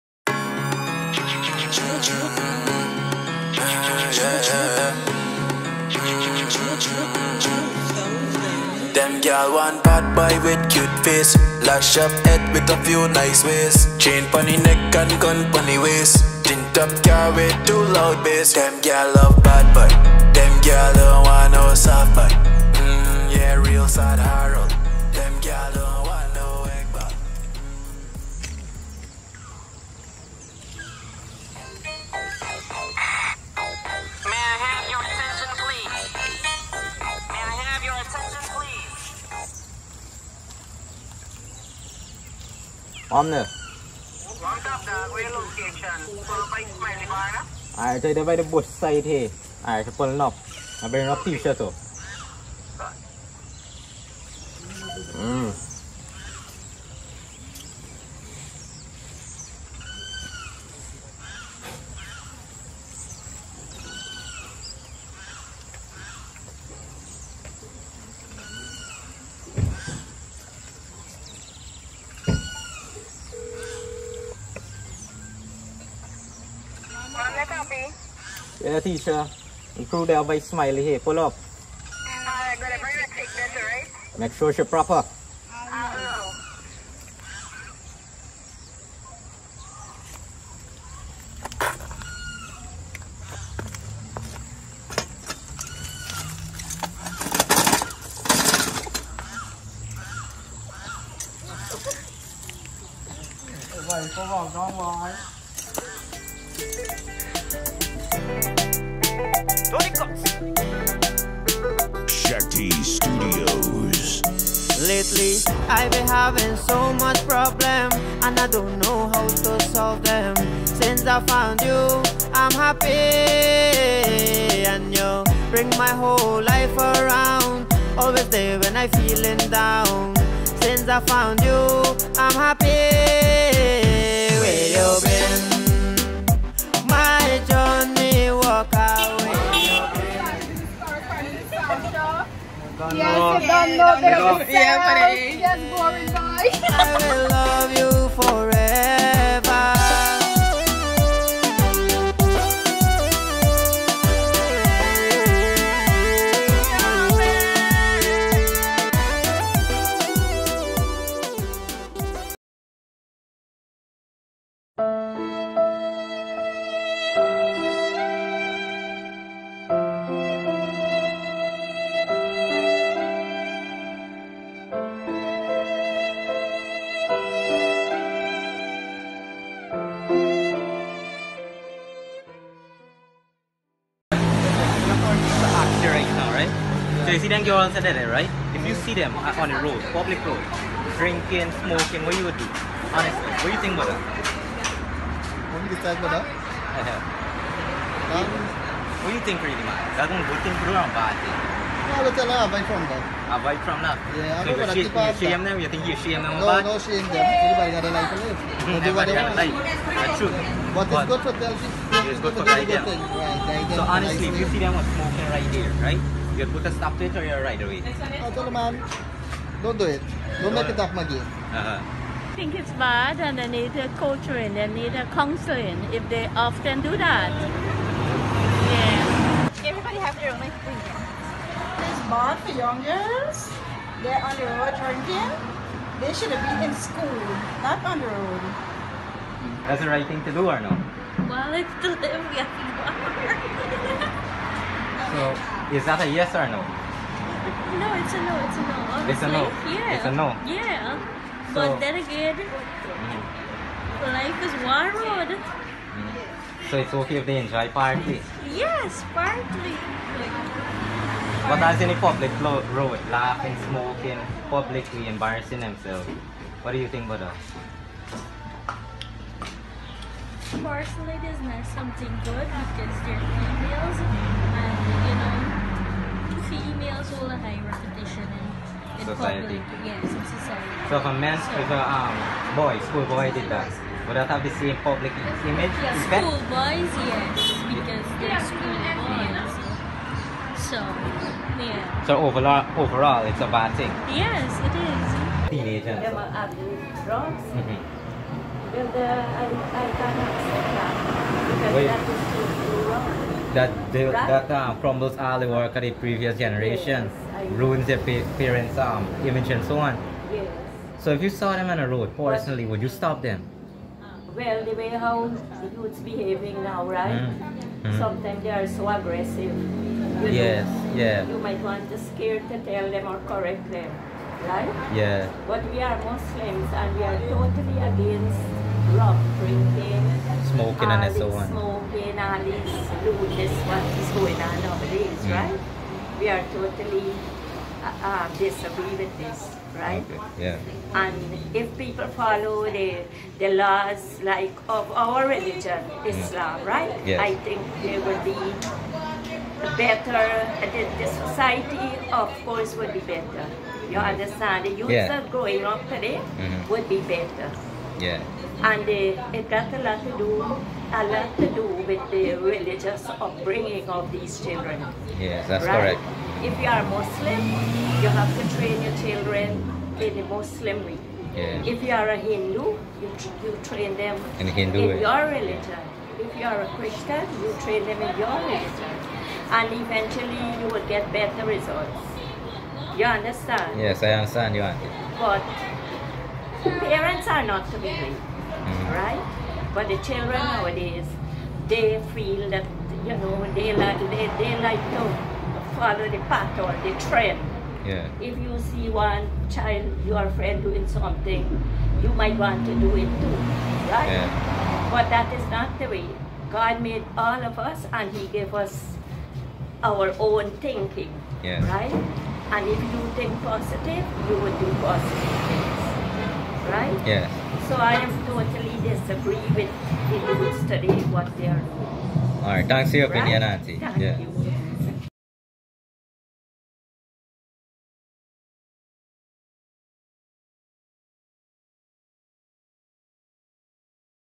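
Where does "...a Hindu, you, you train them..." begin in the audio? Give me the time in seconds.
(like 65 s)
372 s.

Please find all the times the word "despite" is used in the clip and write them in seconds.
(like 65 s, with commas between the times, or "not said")
not said.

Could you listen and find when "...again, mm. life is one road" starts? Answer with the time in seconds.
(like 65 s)
251 s.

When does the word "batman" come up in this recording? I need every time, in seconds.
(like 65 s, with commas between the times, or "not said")
not said.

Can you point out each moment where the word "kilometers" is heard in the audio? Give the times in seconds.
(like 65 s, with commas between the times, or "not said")
not said.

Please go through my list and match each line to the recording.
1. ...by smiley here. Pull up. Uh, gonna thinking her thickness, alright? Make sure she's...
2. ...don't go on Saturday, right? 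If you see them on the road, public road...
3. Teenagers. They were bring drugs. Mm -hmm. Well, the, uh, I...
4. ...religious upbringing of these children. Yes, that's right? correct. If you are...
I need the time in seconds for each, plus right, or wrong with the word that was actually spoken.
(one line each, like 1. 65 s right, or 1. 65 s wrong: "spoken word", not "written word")
1. 80 s wrong: "bring", not "thinking"
2. 187 s right
3. 295 s wrong: "abusing", not "bring"
4. 362 s right.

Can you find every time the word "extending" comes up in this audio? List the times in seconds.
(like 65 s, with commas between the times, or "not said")
not said.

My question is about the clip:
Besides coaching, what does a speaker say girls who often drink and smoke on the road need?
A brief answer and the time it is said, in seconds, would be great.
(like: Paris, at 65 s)
counseling, at 225 s.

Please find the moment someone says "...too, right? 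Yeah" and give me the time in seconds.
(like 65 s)
403 s.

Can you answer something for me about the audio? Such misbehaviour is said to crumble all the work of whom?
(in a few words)
the previous generations.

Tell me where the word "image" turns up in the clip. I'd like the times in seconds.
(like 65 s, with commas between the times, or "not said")
285 s, 309 s.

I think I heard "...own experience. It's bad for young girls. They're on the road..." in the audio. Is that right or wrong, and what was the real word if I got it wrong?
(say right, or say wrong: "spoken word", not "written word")
right.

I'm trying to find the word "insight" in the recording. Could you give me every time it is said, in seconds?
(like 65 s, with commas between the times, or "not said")
not said.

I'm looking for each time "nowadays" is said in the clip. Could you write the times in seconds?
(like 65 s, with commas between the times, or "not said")
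334 s, 390 s.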